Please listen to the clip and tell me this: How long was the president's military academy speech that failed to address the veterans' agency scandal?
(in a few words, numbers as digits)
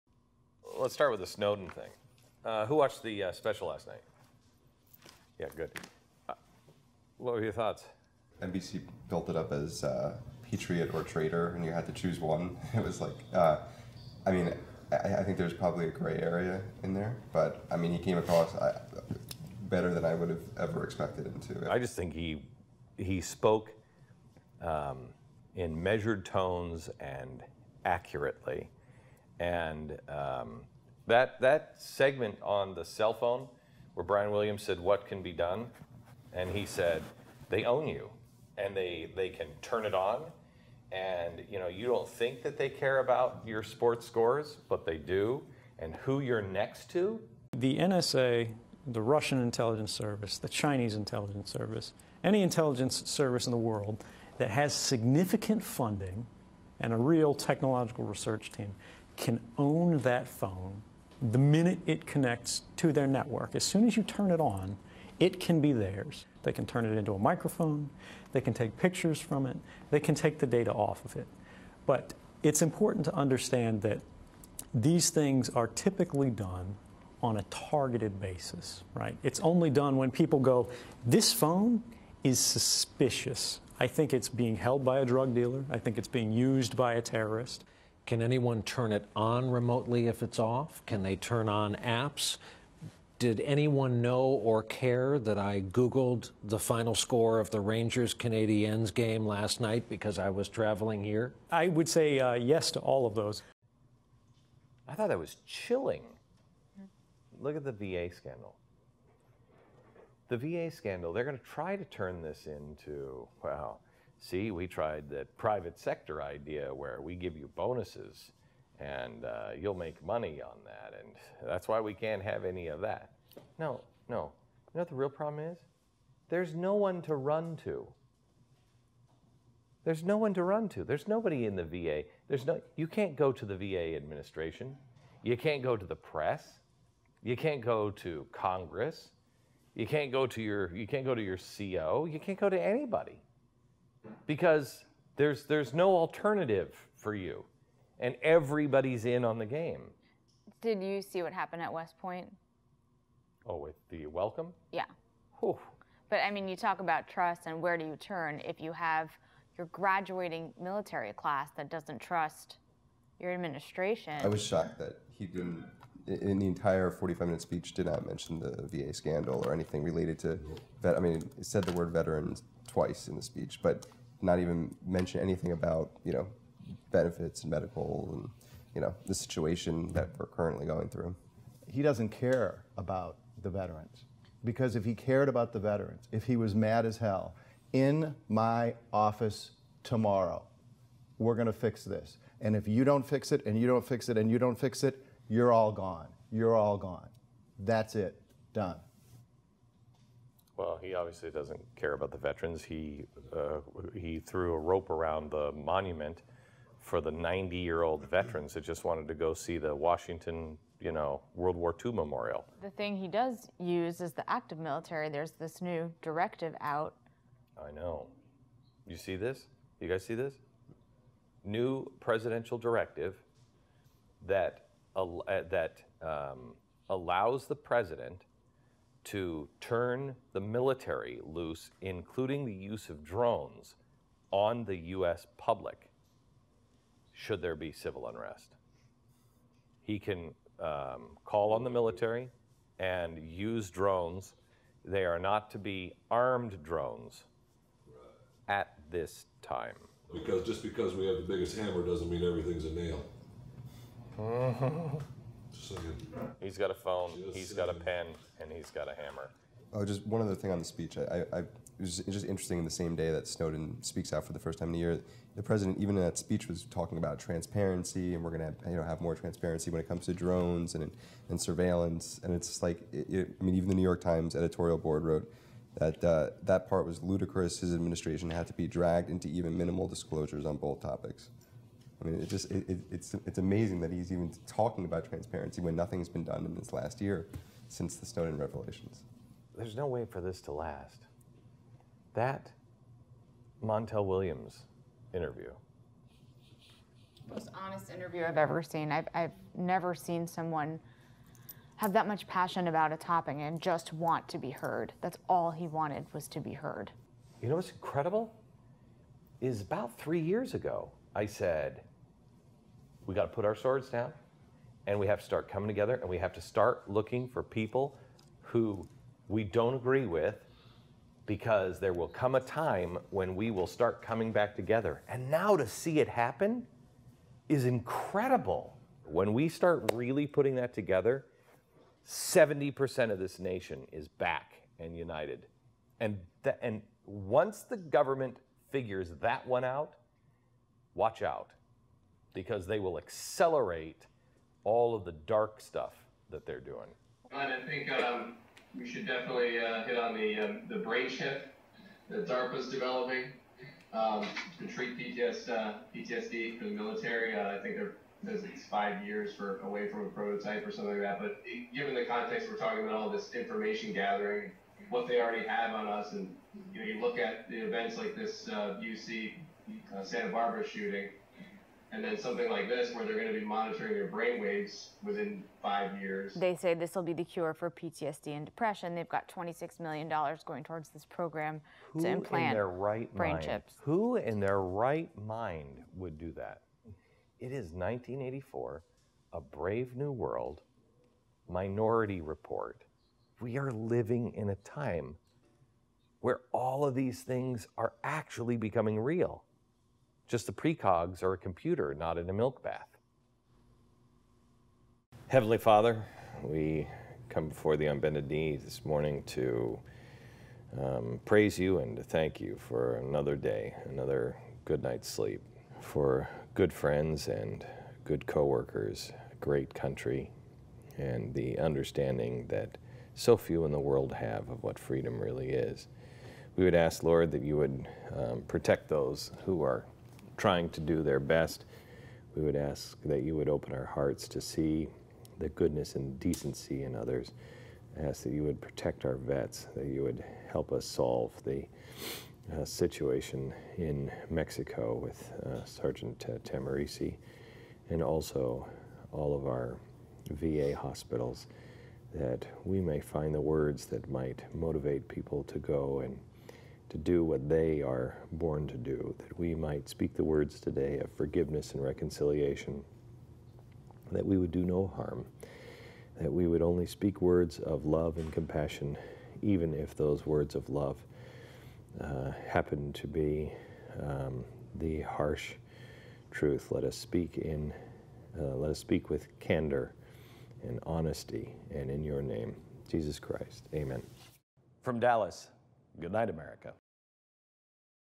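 45 minutes.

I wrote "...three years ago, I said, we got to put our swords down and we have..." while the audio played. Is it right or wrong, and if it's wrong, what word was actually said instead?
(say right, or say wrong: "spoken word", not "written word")
right.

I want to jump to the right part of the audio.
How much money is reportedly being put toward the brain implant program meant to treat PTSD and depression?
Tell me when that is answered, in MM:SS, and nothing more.
06:19.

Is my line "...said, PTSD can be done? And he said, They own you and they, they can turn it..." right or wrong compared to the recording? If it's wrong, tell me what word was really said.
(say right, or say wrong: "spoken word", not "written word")
wrong: "What", not "PTSD".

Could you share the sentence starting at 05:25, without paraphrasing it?
And now to see it happen is incredible.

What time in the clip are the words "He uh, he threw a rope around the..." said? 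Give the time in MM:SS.
03:22.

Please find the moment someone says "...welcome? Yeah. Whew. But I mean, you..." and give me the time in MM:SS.
02:34.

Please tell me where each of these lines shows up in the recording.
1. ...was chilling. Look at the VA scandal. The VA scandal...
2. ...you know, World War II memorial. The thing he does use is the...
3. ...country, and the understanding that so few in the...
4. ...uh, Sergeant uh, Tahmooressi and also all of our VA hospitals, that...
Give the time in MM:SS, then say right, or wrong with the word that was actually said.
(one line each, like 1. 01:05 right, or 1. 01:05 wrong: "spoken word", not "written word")
1. 01:45 right
2. 03:30 right
3. 06:59 right
4. 07:25 right.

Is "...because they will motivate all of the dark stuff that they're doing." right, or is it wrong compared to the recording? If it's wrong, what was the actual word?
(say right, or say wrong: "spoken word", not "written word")
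wrong: "accelerate", not "motivate".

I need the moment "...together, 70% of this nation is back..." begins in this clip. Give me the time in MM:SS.
05:30.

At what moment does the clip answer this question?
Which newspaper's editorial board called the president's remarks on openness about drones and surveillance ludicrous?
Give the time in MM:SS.
04:33.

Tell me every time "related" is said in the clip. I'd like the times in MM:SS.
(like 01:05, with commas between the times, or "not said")
02:49.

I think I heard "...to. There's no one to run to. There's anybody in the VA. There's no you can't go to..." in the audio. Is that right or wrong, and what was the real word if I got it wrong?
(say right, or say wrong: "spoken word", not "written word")
wrong: "nobody", not "anybody".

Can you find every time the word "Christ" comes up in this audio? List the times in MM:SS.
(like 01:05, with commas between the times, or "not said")
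08:03.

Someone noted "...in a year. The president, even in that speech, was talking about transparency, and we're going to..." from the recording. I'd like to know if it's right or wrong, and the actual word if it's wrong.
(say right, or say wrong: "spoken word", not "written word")
right.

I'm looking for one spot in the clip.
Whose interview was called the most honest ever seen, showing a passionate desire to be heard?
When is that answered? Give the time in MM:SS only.
04:53.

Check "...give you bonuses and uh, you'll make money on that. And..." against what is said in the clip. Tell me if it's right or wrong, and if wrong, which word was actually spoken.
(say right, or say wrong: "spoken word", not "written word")
right.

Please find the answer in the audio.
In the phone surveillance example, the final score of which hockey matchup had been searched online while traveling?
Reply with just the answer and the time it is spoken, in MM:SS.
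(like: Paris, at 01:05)
Rangers Canadiens, at 01:37.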